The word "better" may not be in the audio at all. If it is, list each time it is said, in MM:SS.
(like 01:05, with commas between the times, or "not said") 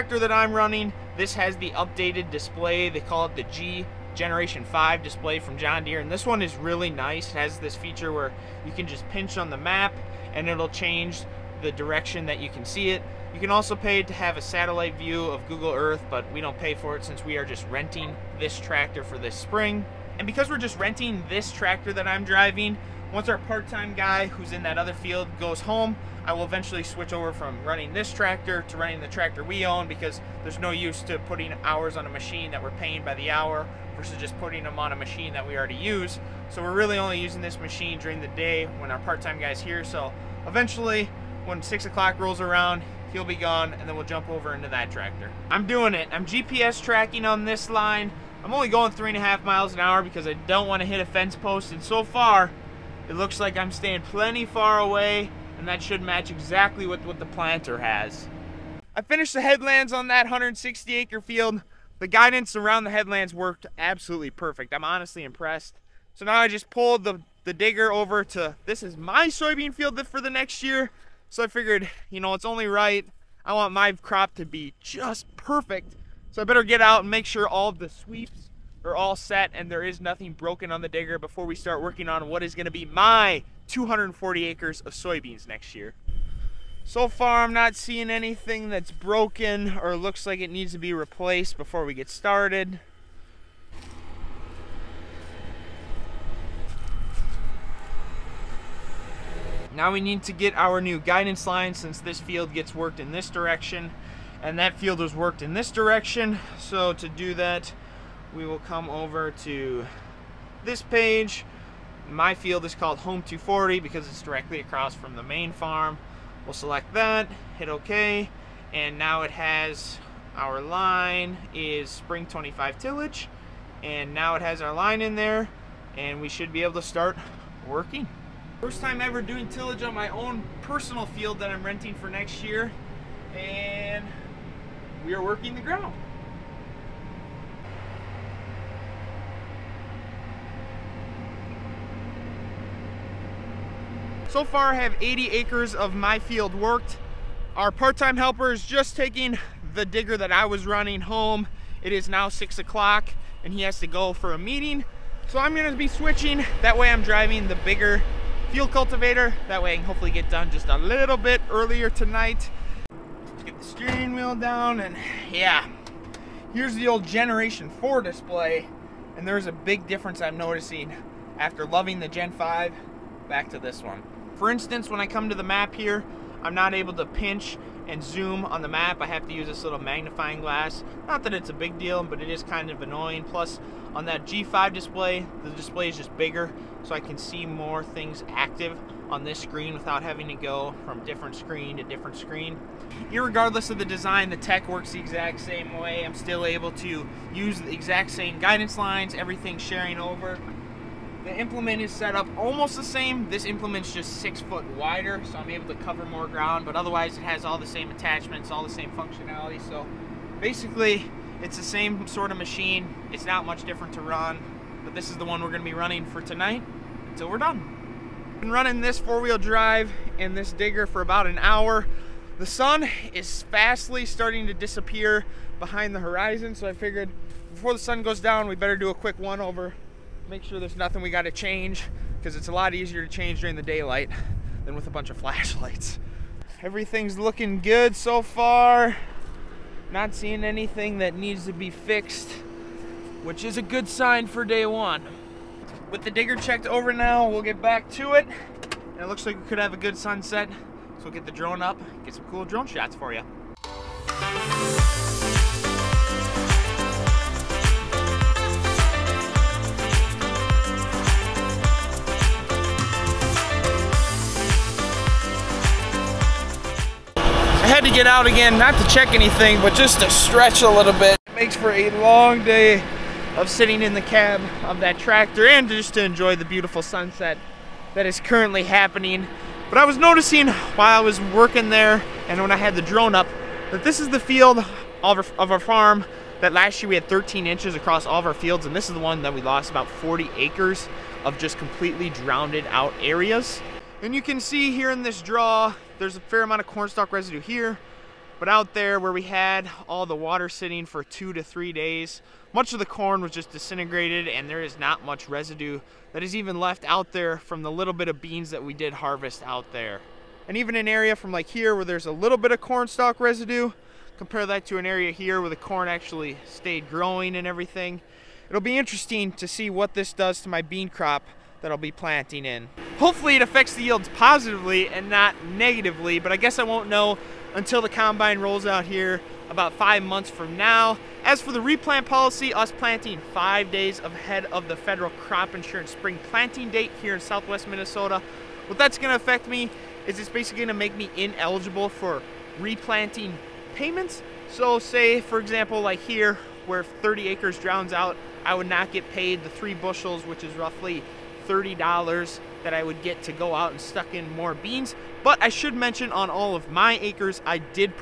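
01:16, 03:48.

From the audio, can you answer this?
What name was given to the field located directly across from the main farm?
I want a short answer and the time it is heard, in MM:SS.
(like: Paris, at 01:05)
Home 240, at 01:52.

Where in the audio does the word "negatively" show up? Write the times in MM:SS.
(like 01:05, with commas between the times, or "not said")
05:25.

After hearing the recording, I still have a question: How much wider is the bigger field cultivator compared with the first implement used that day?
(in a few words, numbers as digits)
6 feet.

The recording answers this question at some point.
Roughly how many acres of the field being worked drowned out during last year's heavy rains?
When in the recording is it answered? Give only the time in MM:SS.
04:49.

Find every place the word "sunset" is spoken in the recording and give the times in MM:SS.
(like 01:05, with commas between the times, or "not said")
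04:09, 04:36.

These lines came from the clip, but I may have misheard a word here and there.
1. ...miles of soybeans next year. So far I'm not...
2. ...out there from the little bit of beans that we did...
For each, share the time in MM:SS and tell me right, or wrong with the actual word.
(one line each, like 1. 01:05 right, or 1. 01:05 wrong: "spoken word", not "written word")
1. 01:24 wrong: "acres", not "miles"
2. 05:06 right.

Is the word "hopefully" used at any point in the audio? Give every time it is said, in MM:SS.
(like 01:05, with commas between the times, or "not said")
02:39, 05:22.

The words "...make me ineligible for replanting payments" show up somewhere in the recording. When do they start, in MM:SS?
05:40.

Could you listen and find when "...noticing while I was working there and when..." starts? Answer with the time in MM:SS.
04:39.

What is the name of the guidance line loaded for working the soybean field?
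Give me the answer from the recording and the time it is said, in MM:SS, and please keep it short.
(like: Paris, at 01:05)
spring 25 tillage, at 02:01.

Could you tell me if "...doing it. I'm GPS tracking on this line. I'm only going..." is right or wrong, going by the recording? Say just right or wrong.
right.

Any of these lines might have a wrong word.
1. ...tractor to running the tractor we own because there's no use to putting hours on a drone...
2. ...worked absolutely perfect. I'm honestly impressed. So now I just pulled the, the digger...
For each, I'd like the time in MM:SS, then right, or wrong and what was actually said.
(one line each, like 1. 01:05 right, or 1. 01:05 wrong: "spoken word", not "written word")
1. 00:28 wrong: "machine", not "drone"
2. 01:03 right.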